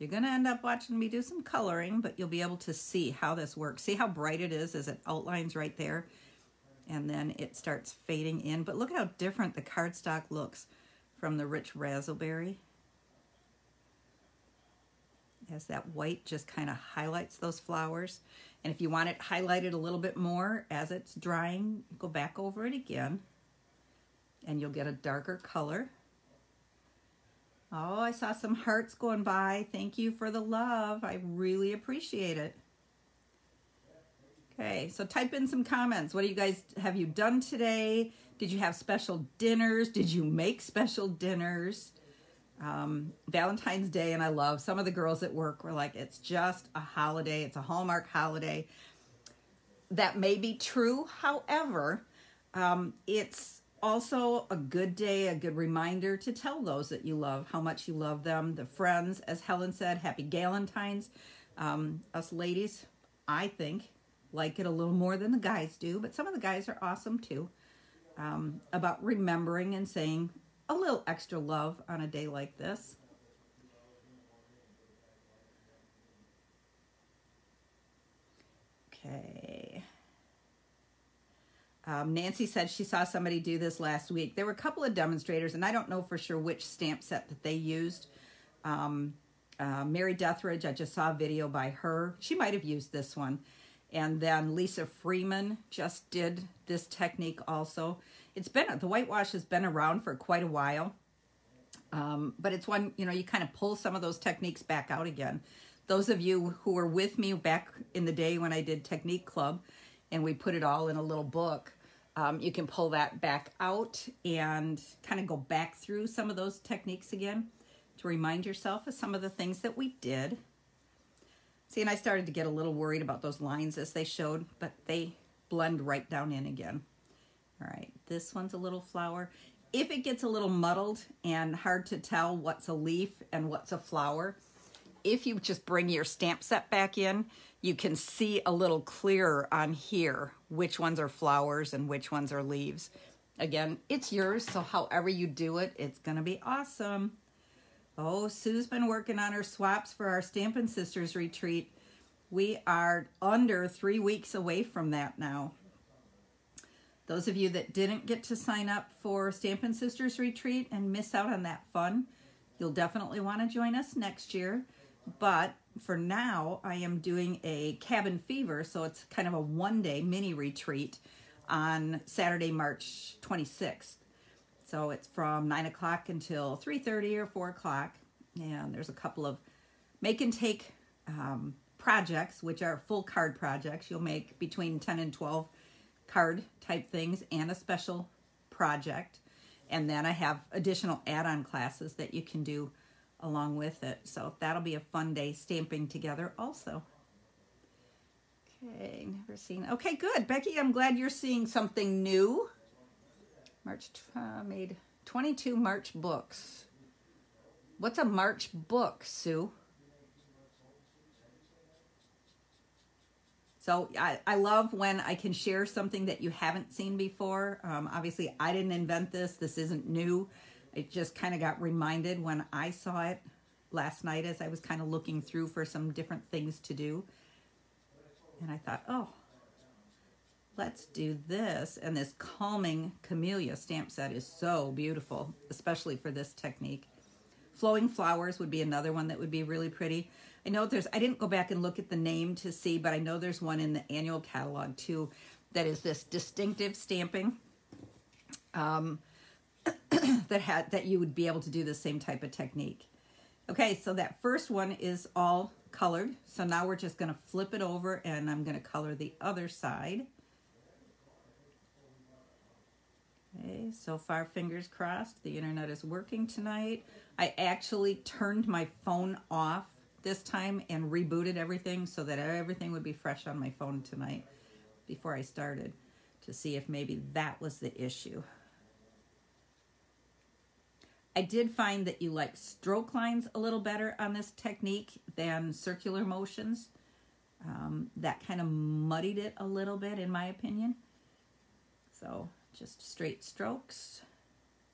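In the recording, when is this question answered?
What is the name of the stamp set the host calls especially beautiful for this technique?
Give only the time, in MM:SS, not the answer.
03:52.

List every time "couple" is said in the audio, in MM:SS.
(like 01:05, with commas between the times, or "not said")
01:24, 02:58.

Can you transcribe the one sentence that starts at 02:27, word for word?
Oh, Sue's been working on her swaps for our Stampin' Sisters retreat.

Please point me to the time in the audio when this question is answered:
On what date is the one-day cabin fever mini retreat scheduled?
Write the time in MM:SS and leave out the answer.
02:52.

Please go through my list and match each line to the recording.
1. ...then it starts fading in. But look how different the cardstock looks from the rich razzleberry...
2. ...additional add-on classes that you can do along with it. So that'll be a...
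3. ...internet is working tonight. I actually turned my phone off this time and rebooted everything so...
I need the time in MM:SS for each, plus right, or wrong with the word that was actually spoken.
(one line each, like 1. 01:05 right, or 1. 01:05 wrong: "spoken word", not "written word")
1. 00:07 right
2. 03:10 right
3. 04:25 right.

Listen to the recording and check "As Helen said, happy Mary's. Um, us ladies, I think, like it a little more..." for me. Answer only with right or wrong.
wrong.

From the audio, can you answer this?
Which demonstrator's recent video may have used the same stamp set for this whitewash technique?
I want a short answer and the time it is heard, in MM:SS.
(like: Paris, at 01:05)
Mary Deatherage, at 01:29.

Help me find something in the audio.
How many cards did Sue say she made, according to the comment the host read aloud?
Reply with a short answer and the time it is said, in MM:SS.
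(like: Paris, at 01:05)
22, at 03:25.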